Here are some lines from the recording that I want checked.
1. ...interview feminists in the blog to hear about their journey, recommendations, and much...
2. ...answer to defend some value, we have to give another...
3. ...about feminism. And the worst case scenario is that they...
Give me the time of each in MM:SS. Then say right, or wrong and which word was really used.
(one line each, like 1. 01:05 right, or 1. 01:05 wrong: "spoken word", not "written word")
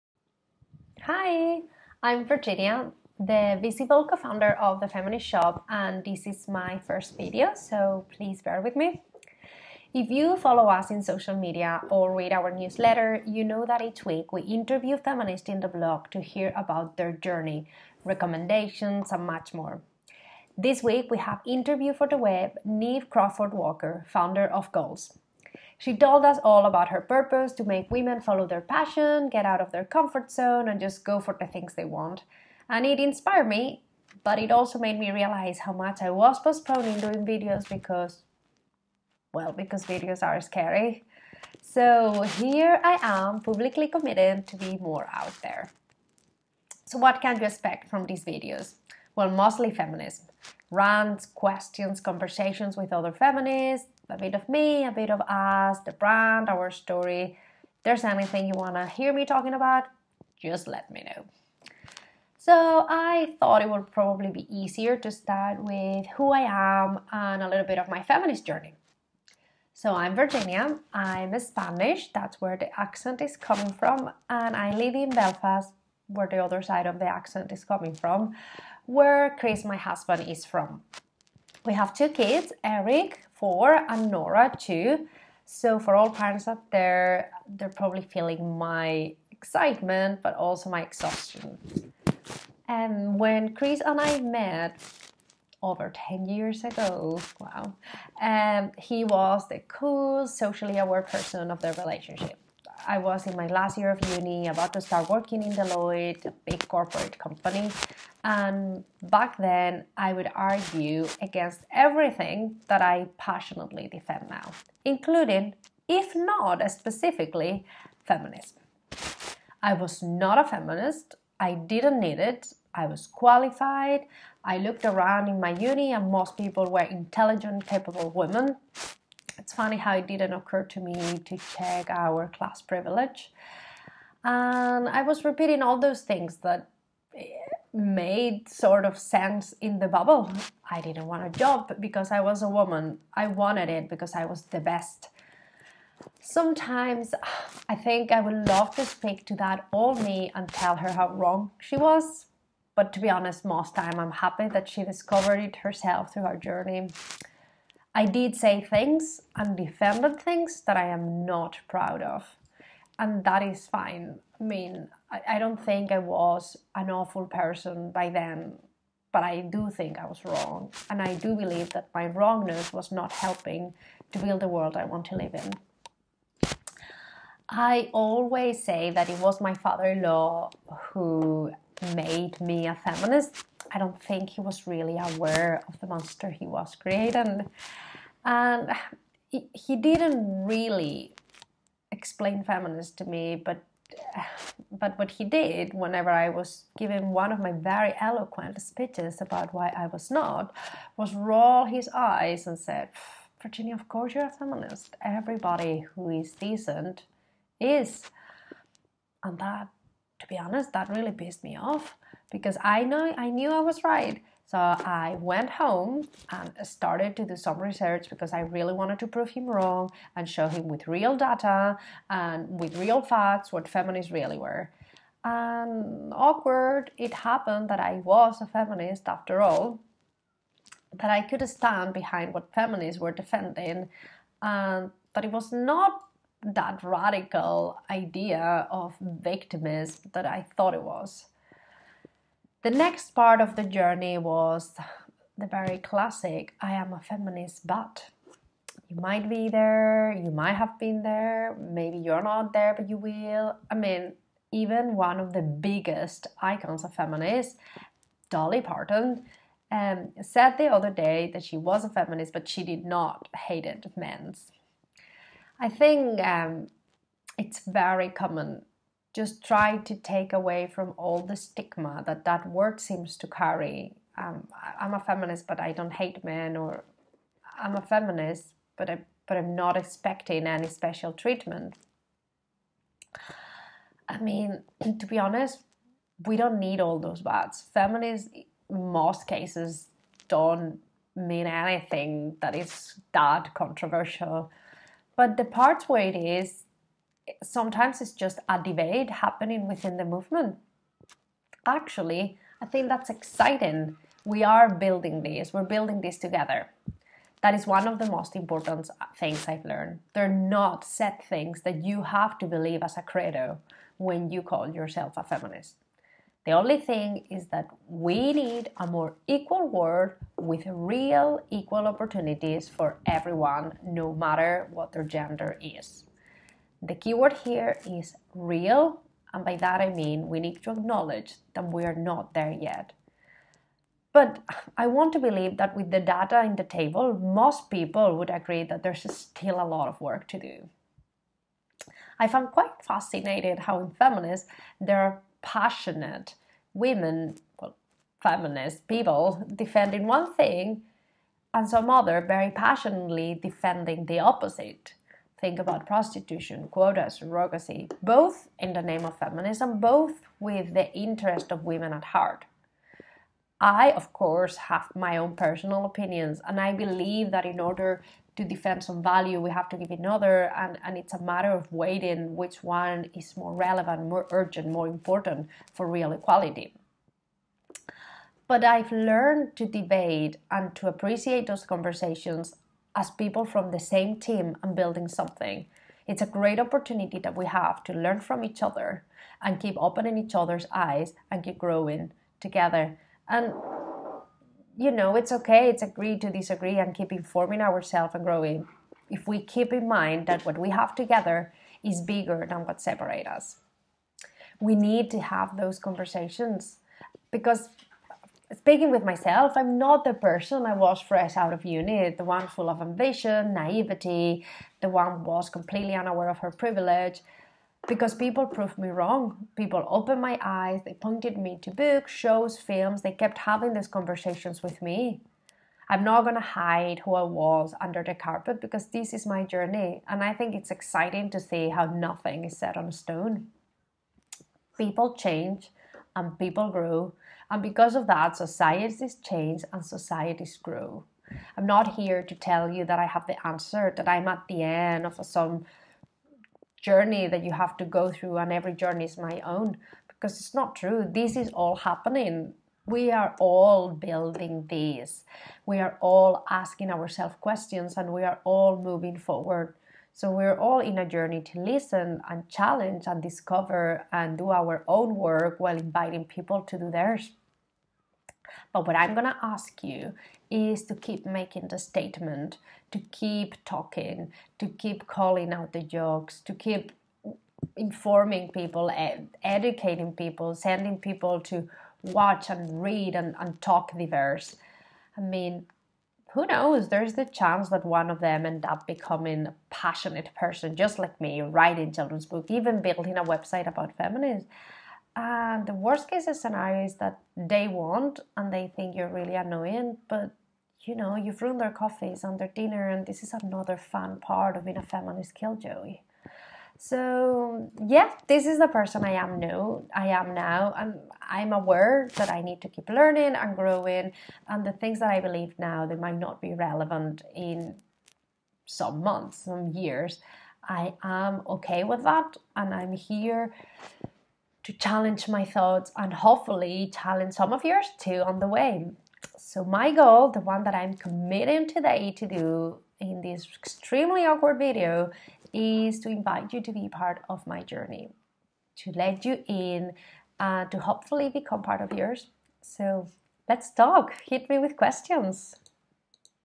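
1. 00:14 right
2. 06:07 wrong: "order", not "answer"
3. 08:13 right.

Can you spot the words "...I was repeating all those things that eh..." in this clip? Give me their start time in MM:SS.
02:14.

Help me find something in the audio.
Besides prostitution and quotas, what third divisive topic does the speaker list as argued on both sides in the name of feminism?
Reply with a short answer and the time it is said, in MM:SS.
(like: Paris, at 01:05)
Surrogacy, at 05:57.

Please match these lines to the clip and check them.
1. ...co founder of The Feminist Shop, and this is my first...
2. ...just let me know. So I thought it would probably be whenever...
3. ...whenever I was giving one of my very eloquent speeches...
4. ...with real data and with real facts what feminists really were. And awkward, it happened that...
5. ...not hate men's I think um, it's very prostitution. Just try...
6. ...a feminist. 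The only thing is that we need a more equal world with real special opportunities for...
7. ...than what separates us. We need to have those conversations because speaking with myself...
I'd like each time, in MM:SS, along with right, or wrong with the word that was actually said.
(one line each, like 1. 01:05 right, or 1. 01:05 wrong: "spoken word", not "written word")
1. 00:04 right
2. 01:00 wrong: "easier", not "whenever"
3. 03:15 right
4. 03:40 right
5. 04:22 wrong: "common", not "prostitution"
6. 05:15 wrong: "equal", not "special"
7. 06:42 right.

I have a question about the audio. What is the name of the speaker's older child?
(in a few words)
Eric.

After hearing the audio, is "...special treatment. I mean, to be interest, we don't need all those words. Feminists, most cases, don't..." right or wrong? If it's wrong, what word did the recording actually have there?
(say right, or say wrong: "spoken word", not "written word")
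wrong: "honest", not "interest".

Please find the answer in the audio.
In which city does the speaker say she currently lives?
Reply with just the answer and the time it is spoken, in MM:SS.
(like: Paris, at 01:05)
Belfast, at 01:15.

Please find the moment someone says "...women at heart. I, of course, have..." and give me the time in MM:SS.
06:01.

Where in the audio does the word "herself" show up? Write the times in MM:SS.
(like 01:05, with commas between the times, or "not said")
02:35.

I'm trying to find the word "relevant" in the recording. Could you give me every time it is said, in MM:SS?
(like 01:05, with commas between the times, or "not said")
06:13, 08:36.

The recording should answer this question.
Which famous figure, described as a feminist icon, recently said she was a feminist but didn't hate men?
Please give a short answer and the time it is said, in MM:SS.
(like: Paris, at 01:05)
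Dolly Parton, at 04:18.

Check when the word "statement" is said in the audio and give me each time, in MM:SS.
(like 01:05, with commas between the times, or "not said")
07:51.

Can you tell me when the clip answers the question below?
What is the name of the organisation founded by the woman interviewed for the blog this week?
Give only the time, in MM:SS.
00:24.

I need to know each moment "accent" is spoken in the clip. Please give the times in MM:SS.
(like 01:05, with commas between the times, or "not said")
01:12, 01:17.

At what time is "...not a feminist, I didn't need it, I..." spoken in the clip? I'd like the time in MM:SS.
02:00.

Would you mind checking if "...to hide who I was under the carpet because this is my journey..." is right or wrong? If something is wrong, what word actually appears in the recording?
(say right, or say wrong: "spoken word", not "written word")
right.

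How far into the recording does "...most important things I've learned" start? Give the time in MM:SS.
05:08.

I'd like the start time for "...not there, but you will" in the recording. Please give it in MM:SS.
04:12.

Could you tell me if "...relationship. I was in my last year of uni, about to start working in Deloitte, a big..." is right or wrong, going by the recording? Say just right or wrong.
right.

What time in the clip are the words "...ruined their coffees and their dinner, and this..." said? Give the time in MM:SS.
08:21.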